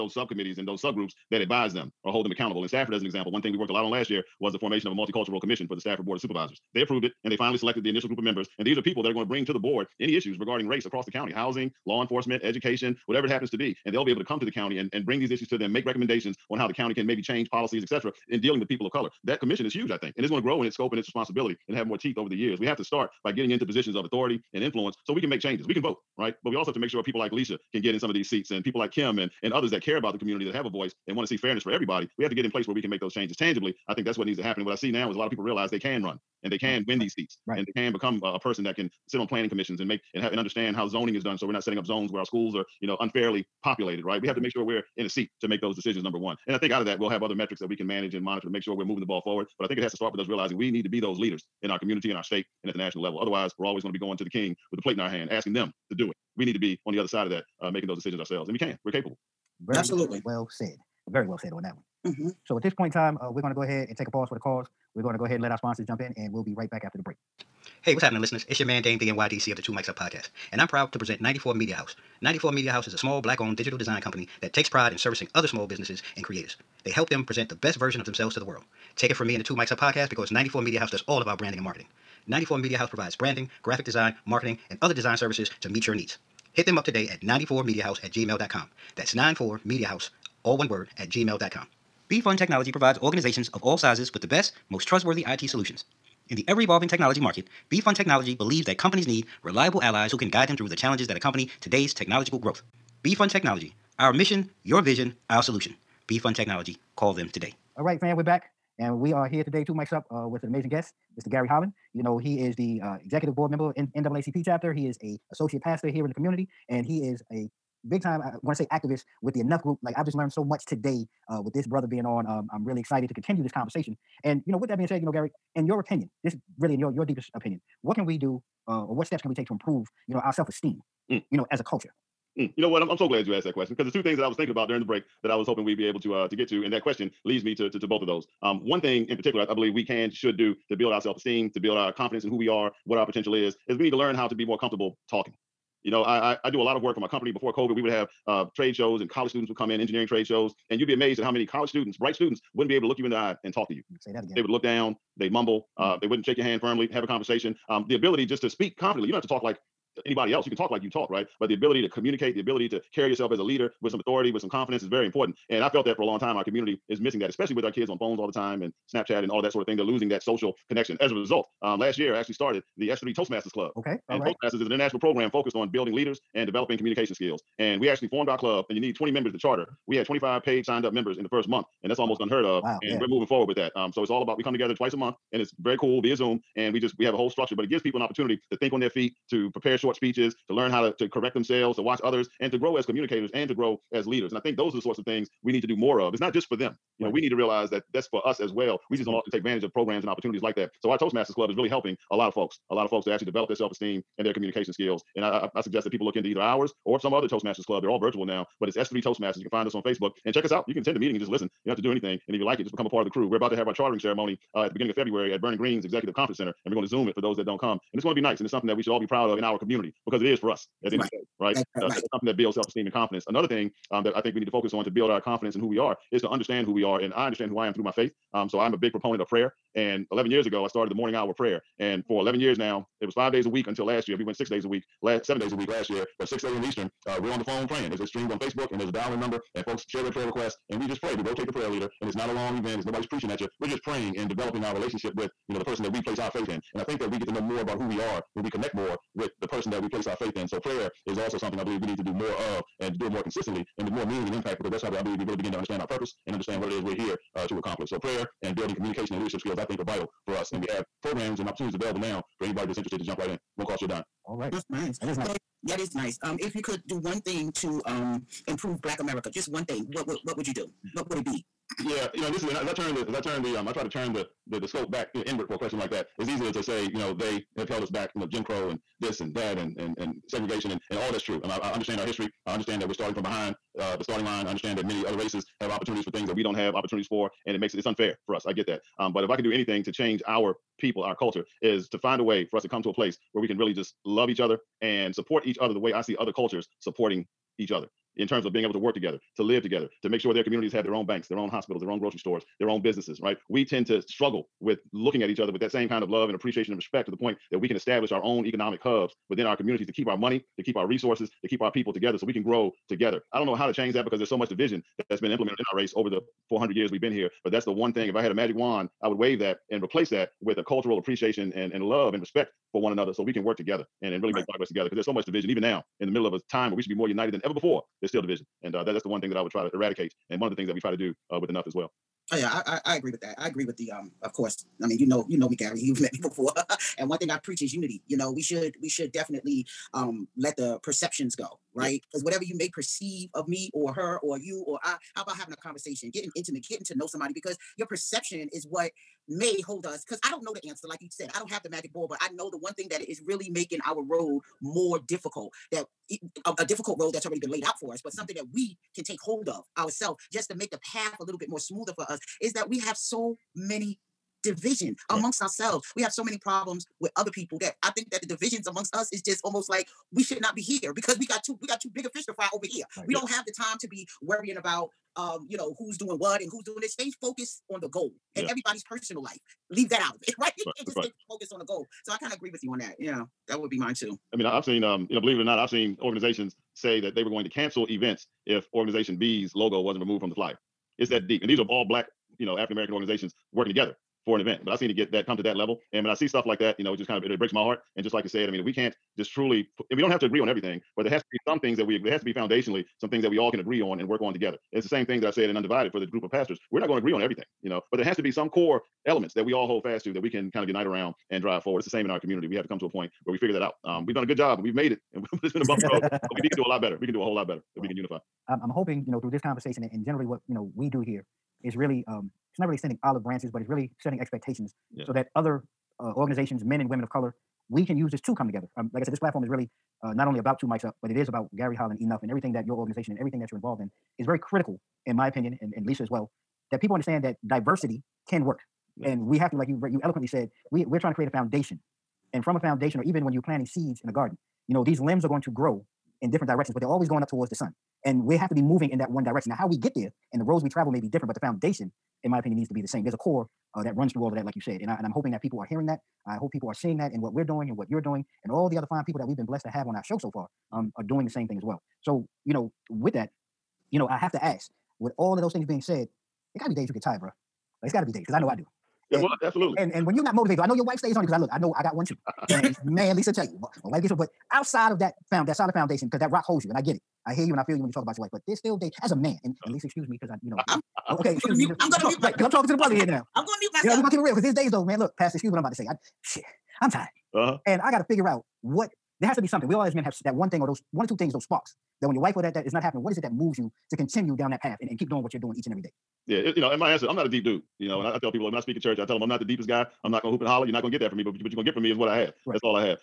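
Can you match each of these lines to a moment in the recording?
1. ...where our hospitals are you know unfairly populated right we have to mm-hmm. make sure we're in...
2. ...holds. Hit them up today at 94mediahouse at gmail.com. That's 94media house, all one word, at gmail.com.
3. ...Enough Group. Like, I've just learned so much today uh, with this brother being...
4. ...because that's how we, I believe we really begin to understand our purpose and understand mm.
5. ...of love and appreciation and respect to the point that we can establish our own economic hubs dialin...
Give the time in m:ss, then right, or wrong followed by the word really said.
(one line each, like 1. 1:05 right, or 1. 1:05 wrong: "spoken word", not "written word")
1. 0:42 wrong: "schools", not "hospitals"
2. 1:25 wrong: "needs", not "holds"
3. 1:59 right
4. 4:14 right
5. 5:06 wrong: "within", not "dialin".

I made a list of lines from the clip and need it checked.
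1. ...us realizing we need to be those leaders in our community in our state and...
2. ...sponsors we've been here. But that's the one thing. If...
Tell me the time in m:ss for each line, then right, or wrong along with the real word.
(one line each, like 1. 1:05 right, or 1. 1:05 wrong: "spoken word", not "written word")
1. 0:50 right
2. 5:16 wrong: "years", not "sponsors".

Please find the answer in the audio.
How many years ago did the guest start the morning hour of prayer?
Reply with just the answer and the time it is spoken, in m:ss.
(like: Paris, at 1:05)
11, at 3:50.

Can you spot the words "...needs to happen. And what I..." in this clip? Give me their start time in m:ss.
0:34.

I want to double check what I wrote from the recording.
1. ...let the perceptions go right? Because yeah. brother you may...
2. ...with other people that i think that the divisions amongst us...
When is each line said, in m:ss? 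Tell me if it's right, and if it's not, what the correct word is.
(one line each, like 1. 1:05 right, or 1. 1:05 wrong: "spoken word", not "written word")
1. 5:40 wrong: "whatever", not "brother"
2. 6:06 right.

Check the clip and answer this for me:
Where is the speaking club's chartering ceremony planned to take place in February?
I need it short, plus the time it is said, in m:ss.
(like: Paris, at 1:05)
Vernon Green's Executive Conference Center, at 3:35.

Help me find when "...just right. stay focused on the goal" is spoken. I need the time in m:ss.
6:20.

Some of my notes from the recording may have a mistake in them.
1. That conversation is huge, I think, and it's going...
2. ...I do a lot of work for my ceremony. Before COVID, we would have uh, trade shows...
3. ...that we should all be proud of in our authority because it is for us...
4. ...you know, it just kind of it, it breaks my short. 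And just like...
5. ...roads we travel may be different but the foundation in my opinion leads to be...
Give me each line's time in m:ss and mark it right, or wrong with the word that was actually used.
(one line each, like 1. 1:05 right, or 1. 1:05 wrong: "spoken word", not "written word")
1. 0:19 wrong: "commission", not "conversation"
2. 2:26 wrong: "company", not "ceremony"
3. 3:38 wrong: "community", not "authority"
4. 6:36 wrong: "heart", not "short"
5. 7:30 wrong: "needs", not "leads".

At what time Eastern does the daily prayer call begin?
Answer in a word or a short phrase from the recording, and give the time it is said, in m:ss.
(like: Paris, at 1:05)
6 a.m., at 3:56.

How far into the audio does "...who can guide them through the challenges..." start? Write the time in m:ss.
1:40.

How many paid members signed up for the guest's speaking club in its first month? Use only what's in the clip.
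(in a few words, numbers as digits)
25.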